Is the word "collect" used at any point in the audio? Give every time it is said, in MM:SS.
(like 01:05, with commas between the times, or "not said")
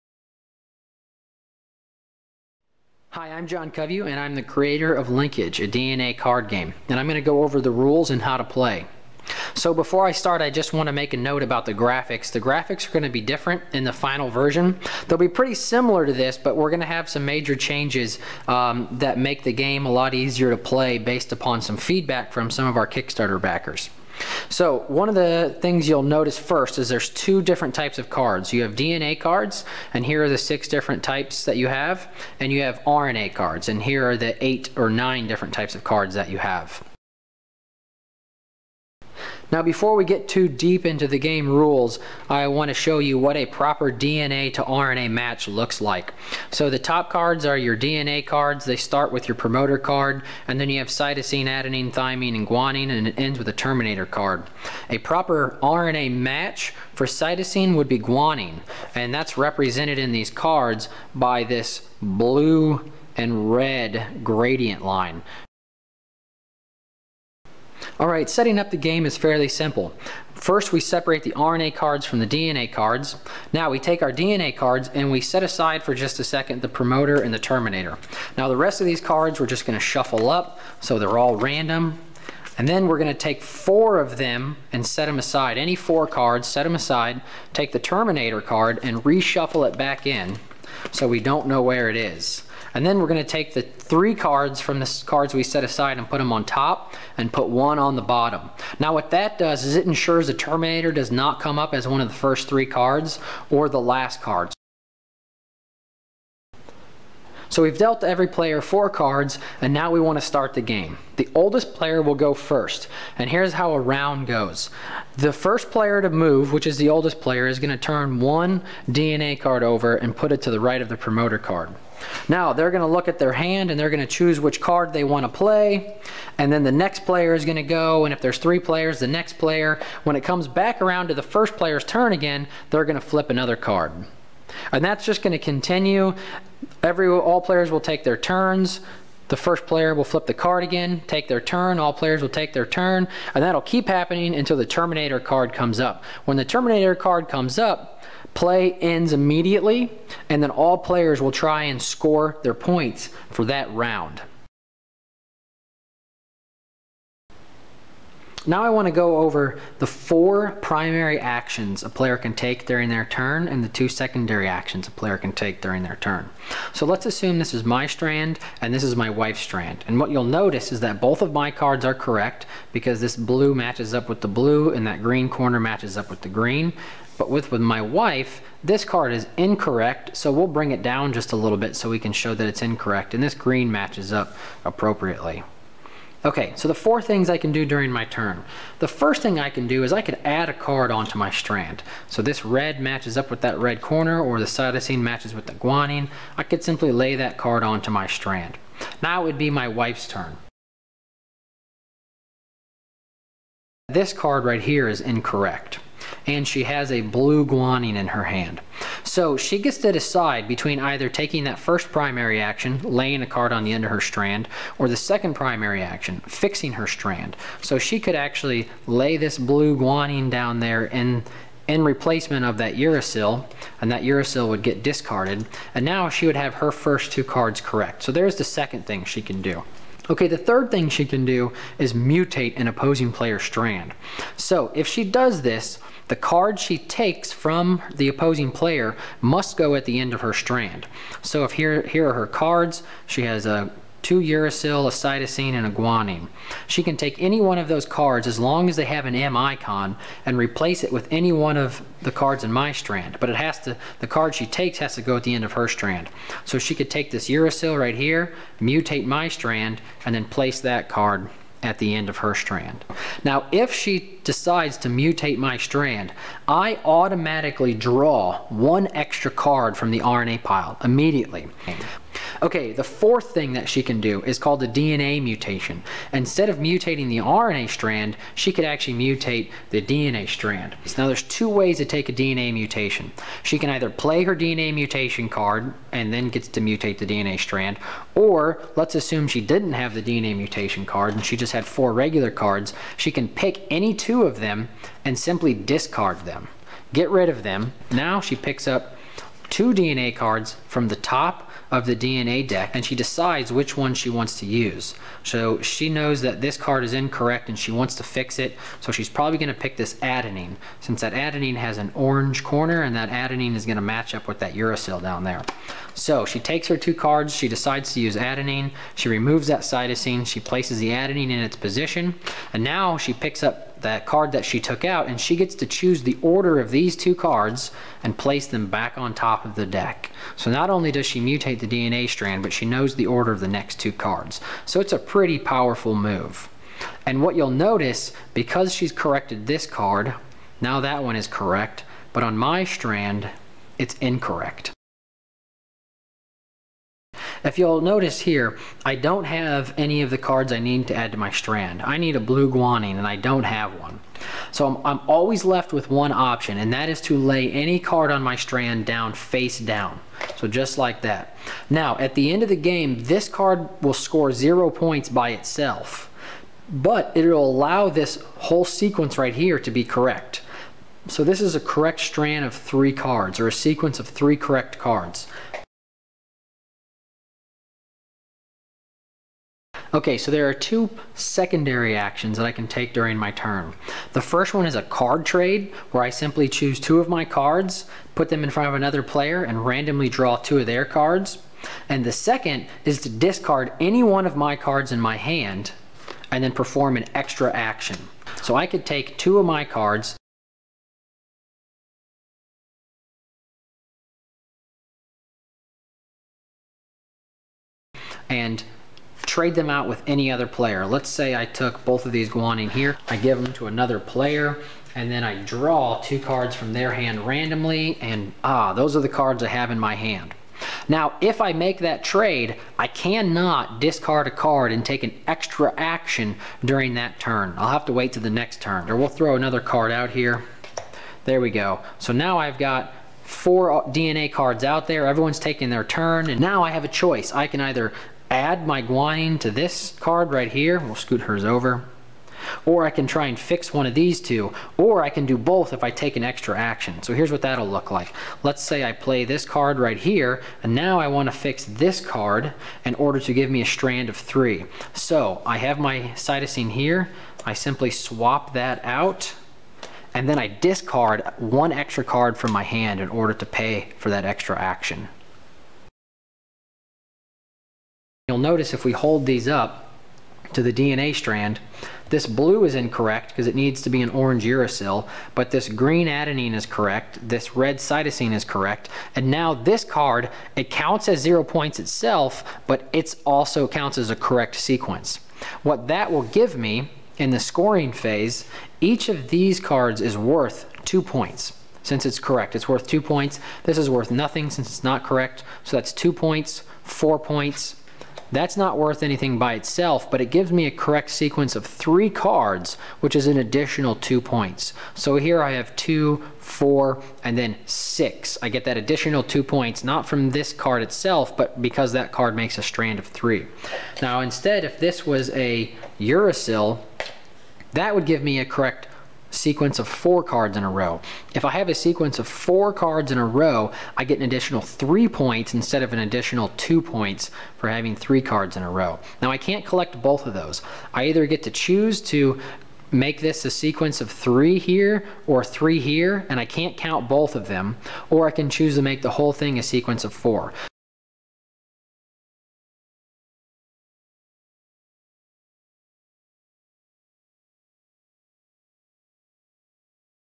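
08:49.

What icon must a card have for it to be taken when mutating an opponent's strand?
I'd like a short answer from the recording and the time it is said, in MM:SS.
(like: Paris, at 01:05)
M icon, at 04:09.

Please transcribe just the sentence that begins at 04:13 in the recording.
But it has to, the card she takes has to go at the end of her strand.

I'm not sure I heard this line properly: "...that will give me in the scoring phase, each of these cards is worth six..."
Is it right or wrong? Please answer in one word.
wrong.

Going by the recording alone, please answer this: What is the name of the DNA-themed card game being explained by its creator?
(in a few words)
Linkage.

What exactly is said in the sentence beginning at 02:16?
Every All players will take their turns.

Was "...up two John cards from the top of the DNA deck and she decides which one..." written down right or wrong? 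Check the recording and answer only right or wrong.
wrong.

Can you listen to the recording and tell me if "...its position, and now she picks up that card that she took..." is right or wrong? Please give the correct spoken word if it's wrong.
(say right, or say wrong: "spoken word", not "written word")
right.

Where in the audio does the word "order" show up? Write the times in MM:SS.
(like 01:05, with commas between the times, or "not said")
05:26, 05:33, 07:32, 07:43.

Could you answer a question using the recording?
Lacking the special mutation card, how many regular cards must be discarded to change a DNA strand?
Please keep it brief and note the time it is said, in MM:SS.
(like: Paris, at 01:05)
2, at 04:53.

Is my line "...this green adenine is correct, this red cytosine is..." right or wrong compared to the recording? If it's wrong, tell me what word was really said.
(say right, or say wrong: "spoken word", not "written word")
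right.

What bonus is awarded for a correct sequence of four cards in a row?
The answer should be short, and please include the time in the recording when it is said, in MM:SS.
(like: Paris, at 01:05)
3 points, at 08:44.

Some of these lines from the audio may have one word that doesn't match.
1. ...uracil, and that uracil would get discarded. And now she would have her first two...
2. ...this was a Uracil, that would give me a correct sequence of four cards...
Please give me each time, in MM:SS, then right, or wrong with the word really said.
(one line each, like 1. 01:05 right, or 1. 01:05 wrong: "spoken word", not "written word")
1. 03:42 right
2. 08:34 right.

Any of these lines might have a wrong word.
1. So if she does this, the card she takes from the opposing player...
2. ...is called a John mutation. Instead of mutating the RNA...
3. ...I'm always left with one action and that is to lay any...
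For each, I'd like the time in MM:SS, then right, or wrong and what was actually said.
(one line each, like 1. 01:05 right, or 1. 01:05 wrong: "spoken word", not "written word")
1. 03:54 right
2. 04:34 wrong: "DNA", not "John"
3. 05:54 wrong: "option", not "action".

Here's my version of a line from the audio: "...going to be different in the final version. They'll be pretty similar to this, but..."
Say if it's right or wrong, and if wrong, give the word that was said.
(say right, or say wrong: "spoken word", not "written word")
right.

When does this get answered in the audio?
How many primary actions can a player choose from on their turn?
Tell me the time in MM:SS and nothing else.
02:39.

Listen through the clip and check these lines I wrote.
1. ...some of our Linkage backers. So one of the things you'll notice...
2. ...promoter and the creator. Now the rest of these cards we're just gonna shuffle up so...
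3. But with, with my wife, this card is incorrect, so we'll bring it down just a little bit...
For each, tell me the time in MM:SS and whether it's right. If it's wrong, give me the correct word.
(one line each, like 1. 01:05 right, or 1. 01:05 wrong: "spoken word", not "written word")
1. 00:22 wrong: "Kickstarter", not "Linkage"
2. 01:16 wrong: "terminator", not "creator"
3. 02:57 right.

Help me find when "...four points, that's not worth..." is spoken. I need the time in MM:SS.
08:16.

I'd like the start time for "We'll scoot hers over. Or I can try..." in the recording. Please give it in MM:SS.
07:20.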